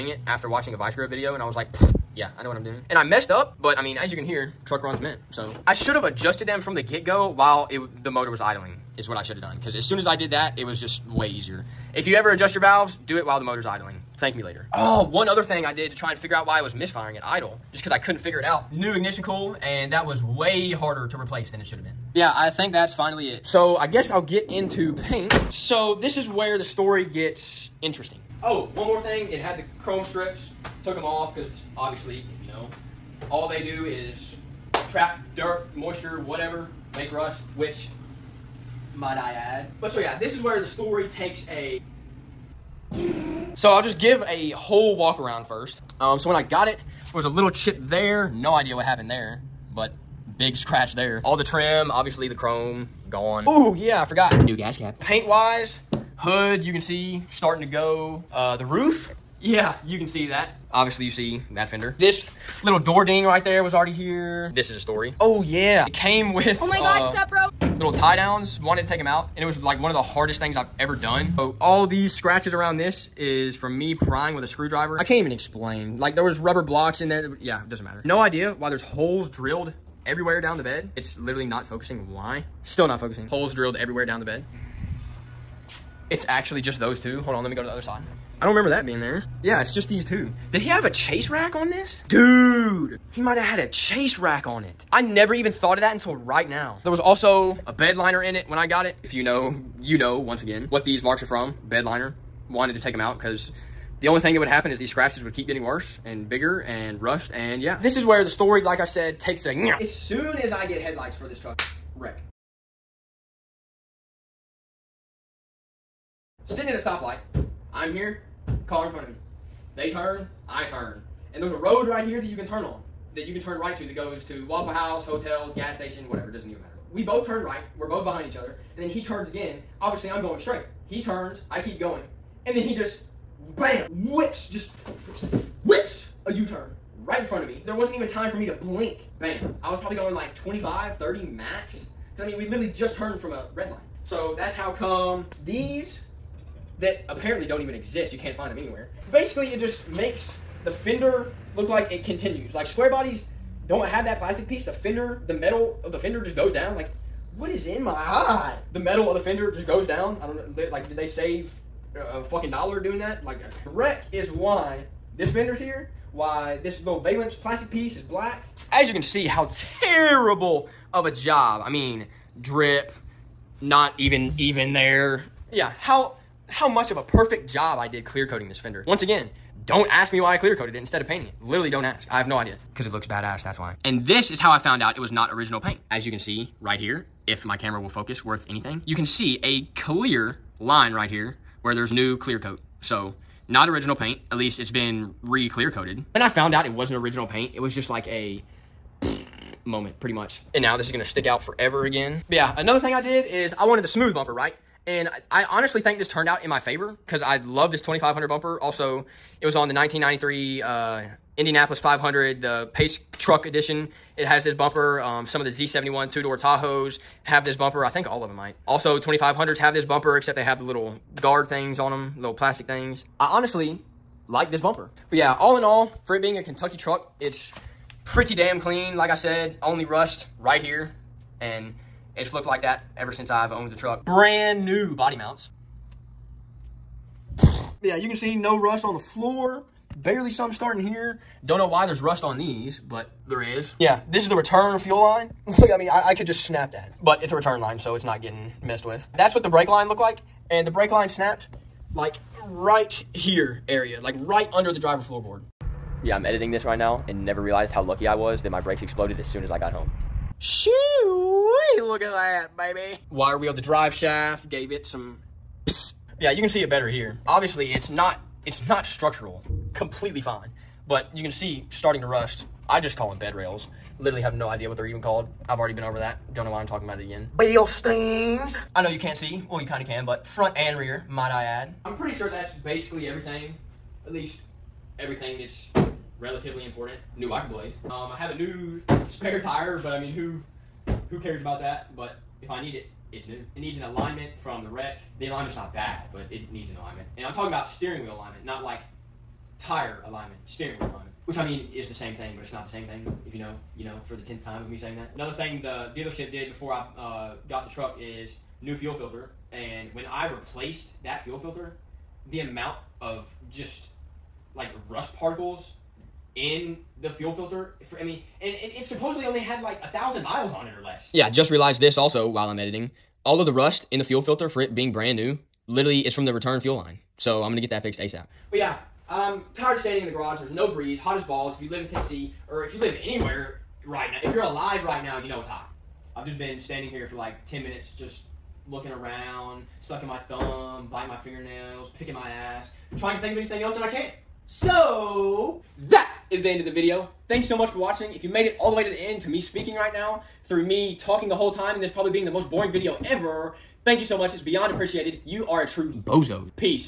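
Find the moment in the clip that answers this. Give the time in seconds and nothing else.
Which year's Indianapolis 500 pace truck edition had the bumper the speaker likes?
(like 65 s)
209 s.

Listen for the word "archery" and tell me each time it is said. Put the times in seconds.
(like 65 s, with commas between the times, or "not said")
not said.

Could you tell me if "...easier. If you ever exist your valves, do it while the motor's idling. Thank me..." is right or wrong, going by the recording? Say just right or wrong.
wrong.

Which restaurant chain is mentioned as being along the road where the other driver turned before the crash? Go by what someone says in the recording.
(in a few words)
Waffle House.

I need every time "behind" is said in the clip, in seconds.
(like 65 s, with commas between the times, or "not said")
128 s.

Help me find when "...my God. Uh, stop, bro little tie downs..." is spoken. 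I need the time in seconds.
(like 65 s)
66 s.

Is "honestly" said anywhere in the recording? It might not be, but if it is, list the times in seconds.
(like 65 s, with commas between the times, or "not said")
205 s, 223 s.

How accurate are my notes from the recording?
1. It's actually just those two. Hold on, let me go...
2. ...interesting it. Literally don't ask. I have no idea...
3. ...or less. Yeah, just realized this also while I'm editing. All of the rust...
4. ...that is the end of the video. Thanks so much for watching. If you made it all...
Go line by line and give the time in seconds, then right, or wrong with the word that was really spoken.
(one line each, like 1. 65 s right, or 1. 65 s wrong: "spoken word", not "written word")
1. 86 s right
2. 181 s wrong: "painting", not "interesting"
3. 320 s right
4. 345 s right.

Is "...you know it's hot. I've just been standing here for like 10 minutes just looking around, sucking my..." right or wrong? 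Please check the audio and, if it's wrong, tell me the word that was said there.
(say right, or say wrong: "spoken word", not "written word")
right.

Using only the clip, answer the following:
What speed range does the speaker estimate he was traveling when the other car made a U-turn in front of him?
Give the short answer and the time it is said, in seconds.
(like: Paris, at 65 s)
25-30, at 140 s.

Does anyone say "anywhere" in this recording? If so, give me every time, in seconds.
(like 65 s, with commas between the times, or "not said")
148 s, 333 s.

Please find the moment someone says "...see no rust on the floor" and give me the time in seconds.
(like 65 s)
238 s.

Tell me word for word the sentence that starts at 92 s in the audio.
Dude, he might have had a chase rack on it.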